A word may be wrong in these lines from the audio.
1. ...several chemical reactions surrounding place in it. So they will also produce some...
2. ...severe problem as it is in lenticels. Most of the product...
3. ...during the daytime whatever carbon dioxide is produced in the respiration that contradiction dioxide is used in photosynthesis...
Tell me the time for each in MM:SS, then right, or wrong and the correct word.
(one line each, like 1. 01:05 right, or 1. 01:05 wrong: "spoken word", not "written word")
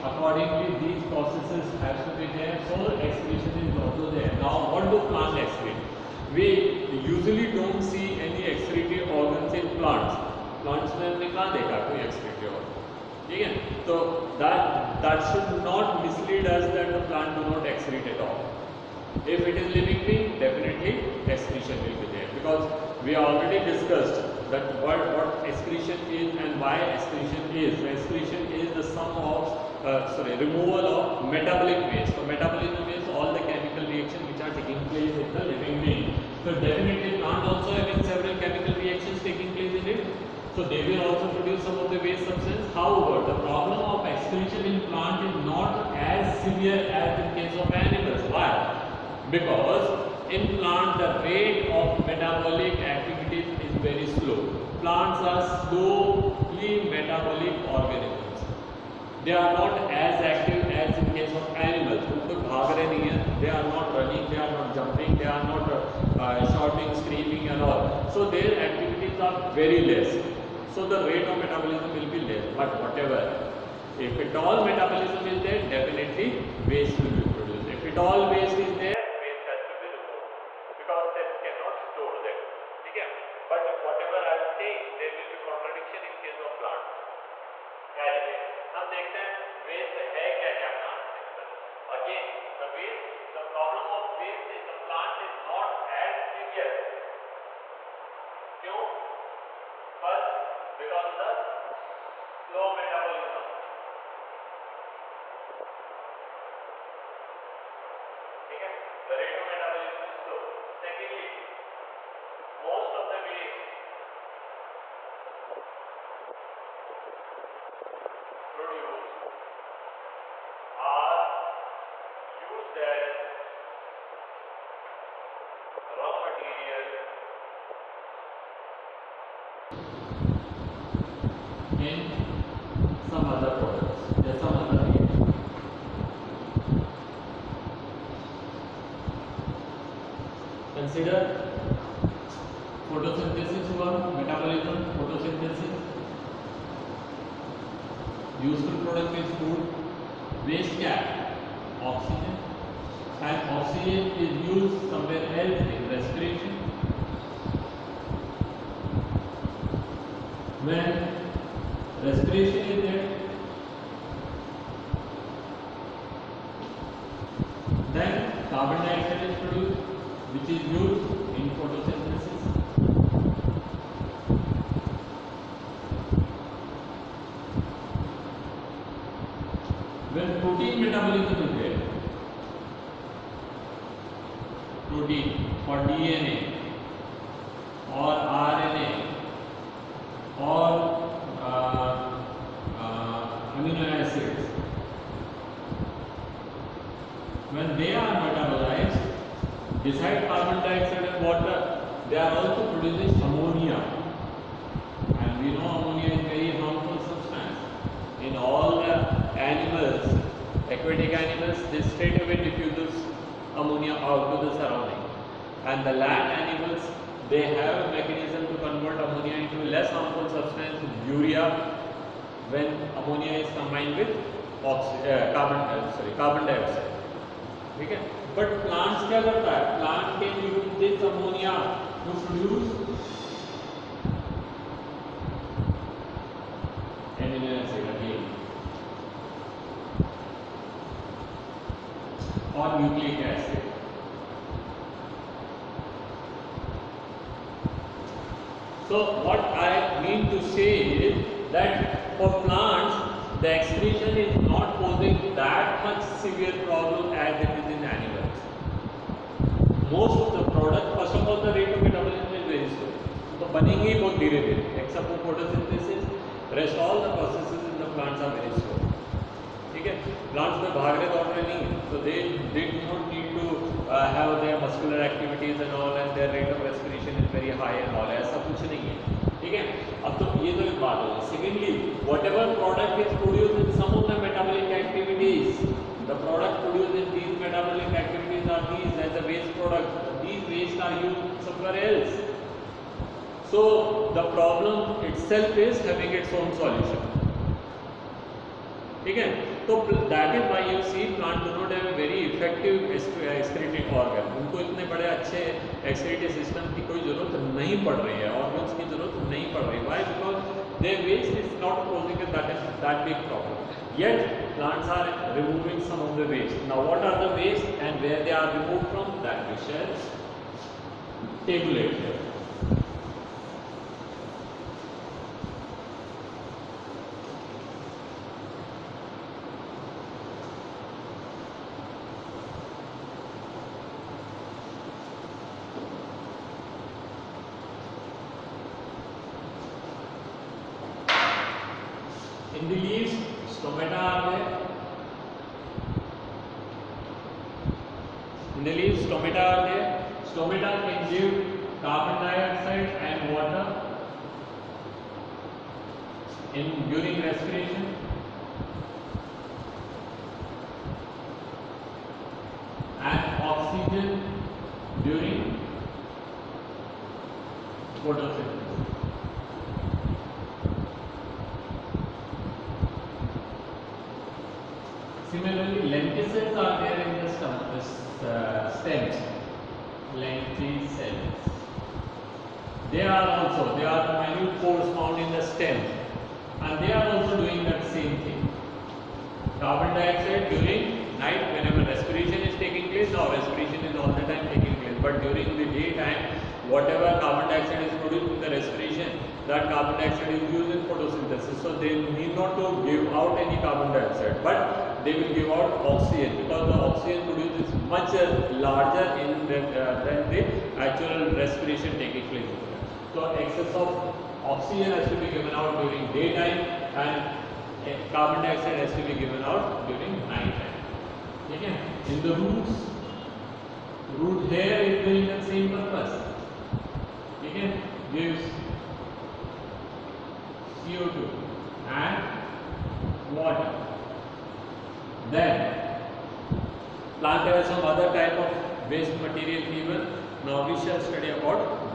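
1. 00:38 wrong: "taking", not "surrounding"
2. 04:16 wrong: "animals", not "lenticels"
3. 06:35 wrong: "carbon", not "contradiction".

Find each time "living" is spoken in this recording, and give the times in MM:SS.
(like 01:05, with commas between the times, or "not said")
00:19, 00:35.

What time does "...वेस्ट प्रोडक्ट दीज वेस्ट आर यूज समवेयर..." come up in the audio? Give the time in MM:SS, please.
04:49.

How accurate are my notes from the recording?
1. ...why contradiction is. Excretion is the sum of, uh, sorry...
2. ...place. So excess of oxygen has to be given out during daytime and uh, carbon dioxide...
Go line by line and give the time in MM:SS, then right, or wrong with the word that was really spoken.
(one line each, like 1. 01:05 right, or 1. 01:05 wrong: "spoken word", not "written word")
1. 00:26 wrong: "excretion", not "contradiction"
2. 06:52 right.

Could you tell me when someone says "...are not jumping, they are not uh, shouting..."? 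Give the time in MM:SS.
01:04.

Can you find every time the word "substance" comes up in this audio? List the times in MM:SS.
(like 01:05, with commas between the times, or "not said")
00:42, 03:40.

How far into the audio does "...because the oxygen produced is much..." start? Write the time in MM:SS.
06:46.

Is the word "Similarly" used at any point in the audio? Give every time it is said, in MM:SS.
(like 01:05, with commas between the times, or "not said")
06:15.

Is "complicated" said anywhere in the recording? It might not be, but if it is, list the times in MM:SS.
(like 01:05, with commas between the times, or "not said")
not said.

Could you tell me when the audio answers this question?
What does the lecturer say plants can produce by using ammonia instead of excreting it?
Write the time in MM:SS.
04:02.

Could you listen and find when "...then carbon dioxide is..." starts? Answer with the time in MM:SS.
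02:47.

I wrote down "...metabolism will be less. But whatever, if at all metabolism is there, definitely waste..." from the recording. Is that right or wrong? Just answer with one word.
right.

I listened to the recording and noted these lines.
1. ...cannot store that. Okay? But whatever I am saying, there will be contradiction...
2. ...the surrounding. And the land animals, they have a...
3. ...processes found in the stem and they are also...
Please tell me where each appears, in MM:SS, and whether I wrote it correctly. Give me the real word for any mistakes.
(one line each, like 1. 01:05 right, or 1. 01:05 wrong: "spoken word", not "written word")
1. 01:21 right
2. 03:34 right
3. 06:24 wrong: "pores", not "processes".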